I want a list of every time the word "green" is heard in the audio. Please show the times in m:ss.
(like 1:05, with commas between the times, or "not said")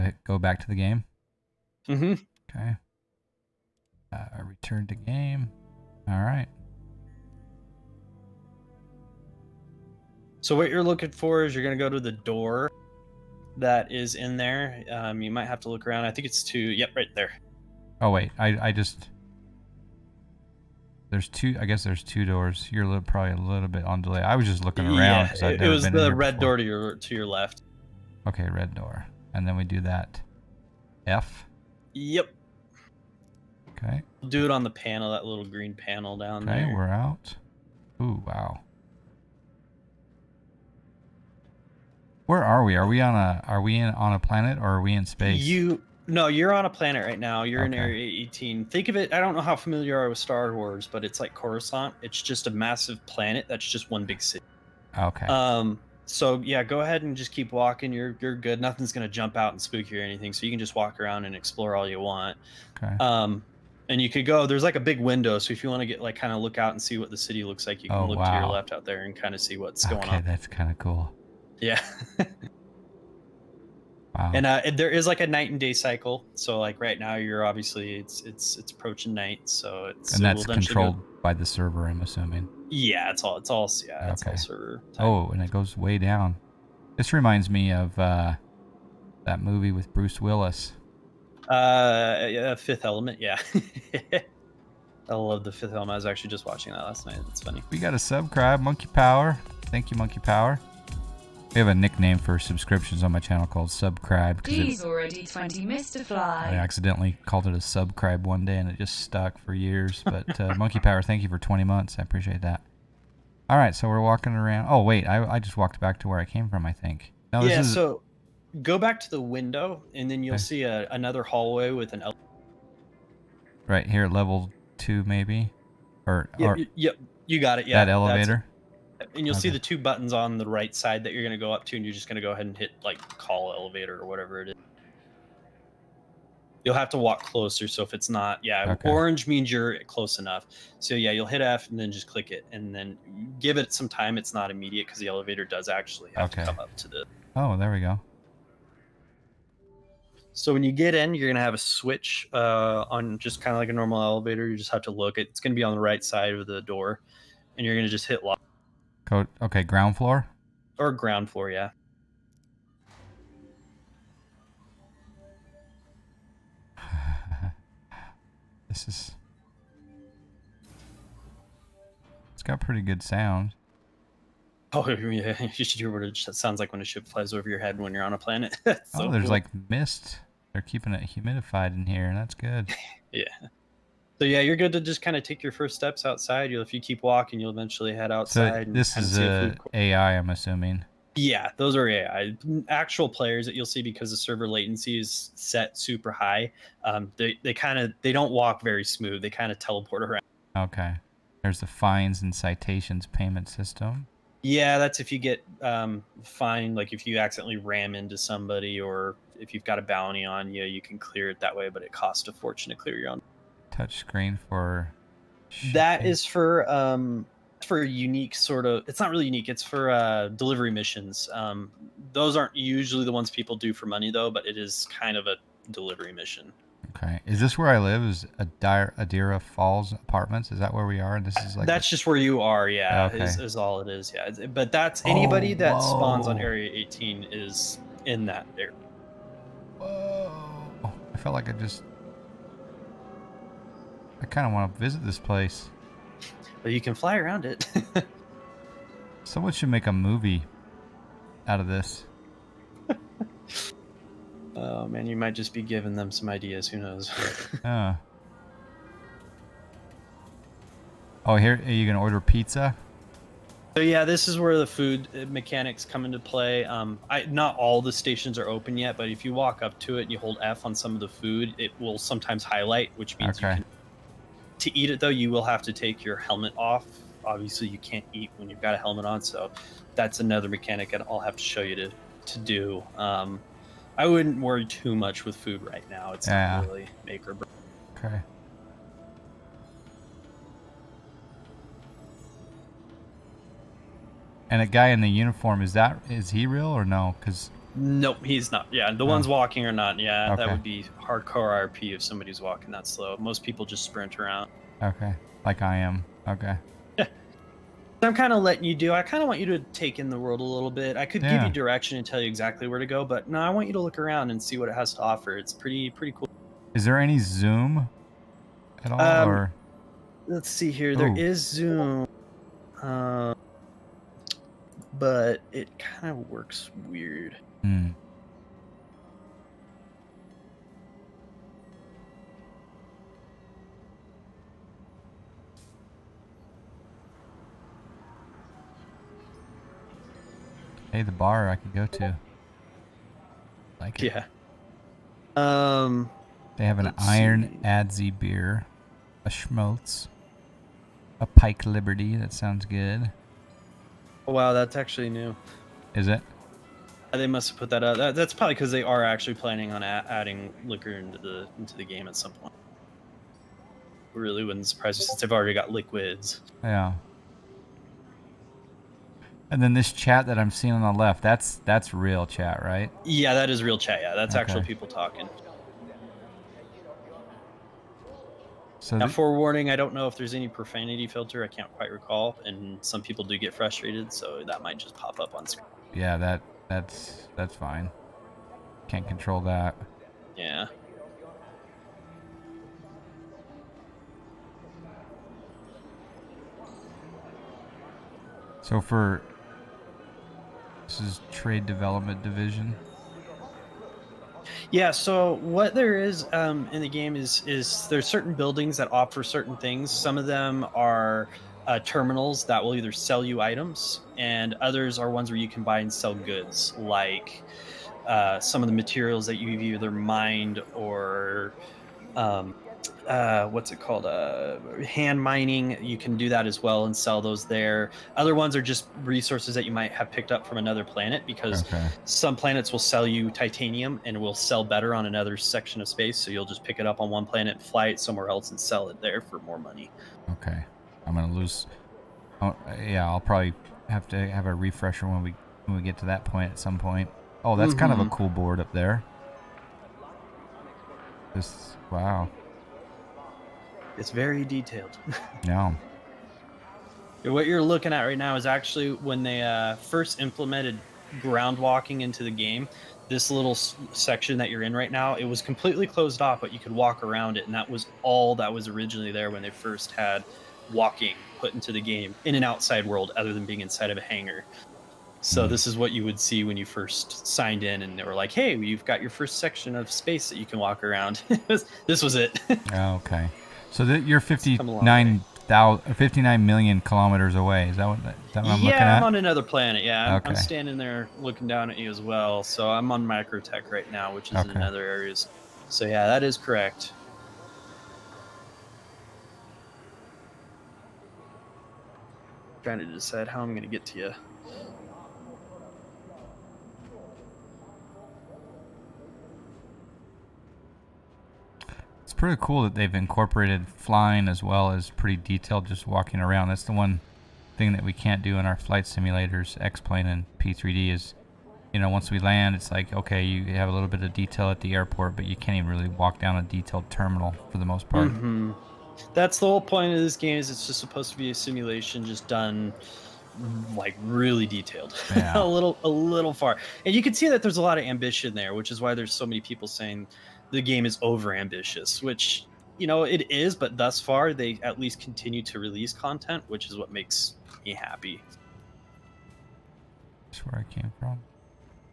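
0:35.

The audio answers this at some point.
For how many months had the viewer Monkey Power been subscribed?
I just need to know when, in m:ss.
1:51.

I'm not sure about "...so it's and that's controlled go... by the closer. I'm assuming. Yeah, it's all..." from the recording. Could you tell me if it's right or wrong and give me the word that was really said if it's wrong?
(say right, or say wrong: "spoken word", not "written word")
wrong: "server", not "closer".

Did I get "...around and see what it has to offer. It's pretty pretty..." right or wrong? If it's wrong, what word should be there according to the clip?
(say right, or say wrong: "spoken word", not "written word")
right.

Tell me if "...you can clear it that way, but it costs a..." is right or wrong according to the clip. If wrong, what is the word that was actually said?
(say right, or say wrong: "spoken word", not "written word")
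right.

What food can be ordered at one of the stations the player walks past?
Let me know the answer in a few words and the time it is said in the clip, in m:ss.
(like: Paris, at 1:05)
Pizza, at 4:22.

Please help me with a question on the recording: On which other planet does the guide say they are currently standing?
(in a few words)
Microtech.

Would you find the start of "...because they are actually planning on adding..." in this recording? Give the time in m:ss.
5:58.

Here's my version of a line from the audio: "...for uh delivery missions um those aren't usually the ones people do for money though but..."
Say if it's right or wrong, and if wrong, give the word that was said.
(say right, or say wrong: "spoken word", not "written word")
right.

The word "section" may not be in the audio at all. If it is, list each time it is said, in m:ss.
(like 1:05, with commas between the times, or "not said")
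7:15, 7:43, 7:59.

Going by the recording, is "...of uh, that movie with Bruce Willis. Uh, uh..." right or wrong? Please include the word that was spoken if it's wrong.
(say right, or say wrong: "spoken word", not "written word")
right.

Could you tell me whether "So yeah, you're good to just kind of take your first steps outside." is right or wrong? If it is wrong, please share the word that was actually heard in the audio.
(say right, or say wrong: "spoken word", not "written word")
right.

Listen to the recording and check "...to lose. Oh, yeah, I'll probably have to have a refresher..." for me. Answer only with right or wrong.
right.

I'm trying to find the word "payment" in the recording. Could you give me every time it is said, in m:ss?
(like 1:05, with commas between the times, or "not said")
3:23.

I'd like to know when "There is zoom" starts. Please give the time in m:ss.
5:20.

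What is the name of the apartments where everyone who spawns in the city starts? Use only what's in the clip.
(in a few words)
Adira Falls apartments.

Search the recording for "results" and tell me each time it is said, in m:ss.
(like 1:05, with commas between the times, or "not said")
not said.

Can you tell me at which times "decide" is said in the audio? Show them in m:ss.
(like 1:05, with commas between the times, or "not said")
8:22.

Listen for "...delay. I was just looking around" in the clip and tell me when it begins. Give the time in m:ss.
0:24.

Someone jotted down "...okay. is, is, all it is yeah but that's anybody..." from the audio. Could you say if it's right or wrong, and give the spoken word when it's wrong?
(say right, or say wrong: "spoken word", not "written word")
right.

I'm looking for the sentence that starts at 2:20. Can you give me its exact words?
So yeah, you'll hit F and then just click it and then give it some time.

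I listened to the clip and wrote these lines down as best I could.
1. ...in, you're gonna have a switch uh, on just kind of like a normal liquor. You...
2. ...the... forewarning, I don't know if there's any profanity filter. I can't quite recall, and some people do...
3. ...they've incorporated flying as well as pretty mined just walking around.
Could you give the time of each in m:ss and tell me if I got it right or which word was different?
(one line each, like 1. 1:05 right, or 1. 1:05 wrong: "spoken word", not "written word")
1. 2:30 wrong: "elevator", not "liquor"
2. 6:19 right
3. 8:32 wrong: "detailed", not "mined".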